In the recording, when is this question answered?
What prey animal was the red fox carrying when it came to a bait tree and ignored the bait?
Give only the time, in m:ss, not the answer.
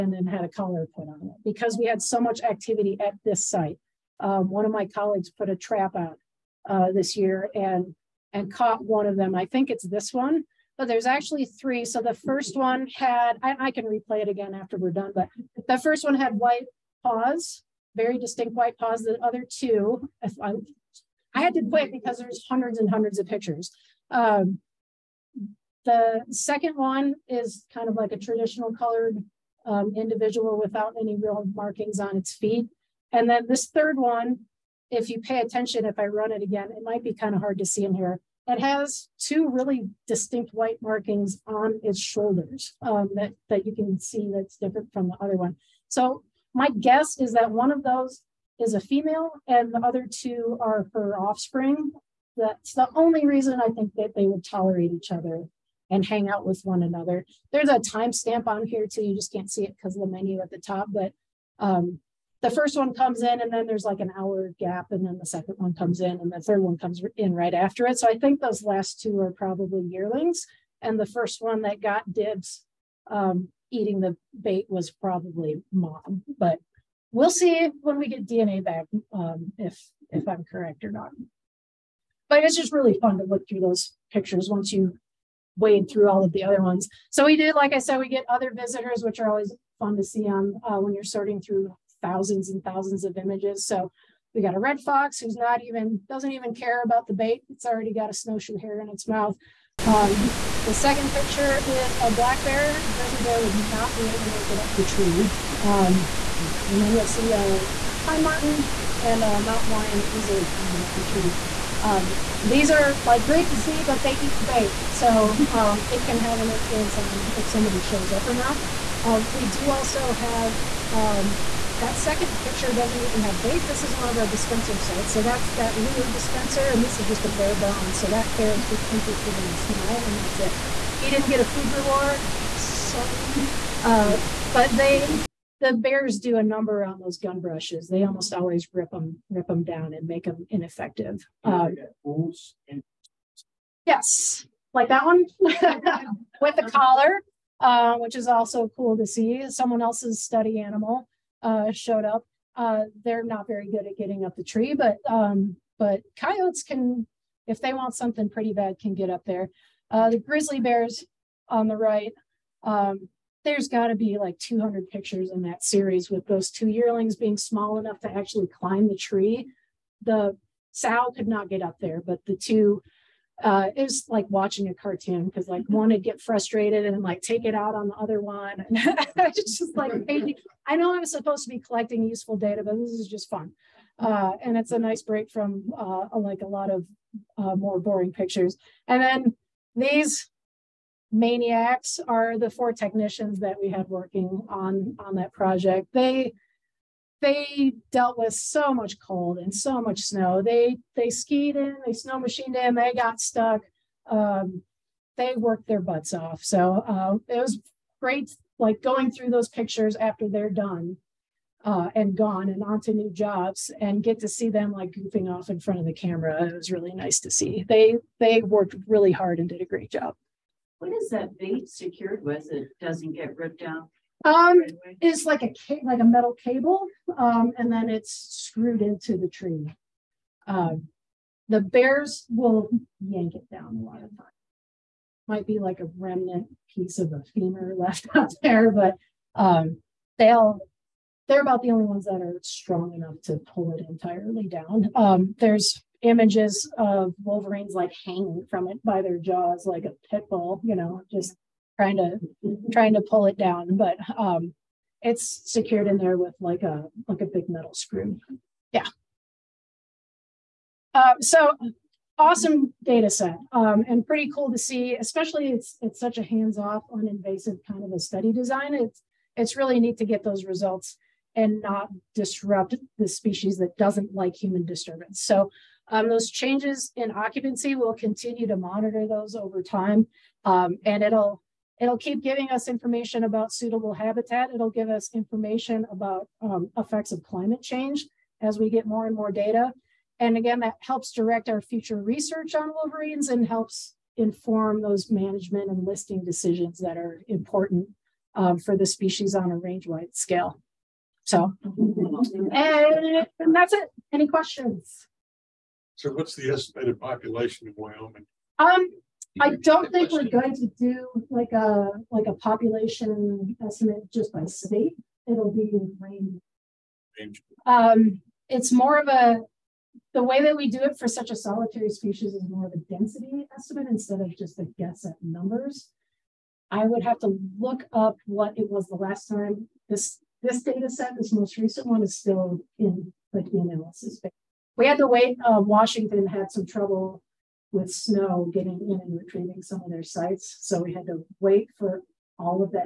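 1:38.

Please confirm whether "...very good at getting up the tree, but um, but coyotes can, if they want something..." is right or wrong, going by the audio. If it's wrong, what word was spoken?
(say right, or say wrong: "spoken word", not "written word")
right.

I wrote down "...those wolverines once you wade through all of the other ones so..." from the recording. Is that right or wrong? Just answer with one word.
wrong.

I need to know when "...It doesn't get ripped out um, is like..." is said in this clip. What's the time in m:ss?
3:42.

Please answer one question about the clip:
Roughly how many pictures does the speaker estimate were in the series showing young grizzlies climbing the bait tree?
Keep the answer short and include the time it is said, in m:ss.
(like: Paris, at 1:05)
200, at 2:44.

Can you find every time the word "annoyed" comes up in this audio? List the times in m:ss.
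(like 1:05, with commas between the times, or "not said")
not said.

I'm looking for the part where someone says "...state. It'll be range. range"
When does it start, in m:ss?
5:14.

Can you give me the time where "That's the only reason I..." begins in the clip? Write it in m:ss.
0:52.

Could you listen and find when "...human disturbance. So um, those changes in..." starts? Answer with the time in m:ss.
4:34.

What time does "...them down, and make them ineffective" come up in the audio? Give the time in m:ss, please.
2:19.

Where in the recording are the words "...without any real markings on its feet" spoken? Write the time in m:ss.
0:30.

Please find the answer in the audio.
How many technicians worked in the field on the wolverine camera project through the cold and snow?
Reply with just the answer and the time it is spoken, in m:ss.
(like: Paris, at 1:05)
4, at 3:12.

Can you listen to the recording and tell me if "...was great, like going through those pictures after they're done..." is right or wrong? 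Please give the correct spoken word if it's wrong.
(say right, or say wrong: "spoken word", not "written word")
right.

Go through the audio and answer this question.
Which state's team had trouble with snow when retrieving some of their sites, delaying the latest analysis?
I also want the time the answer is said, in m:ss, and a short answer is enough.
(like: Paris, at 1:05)
Washington, at 5:35.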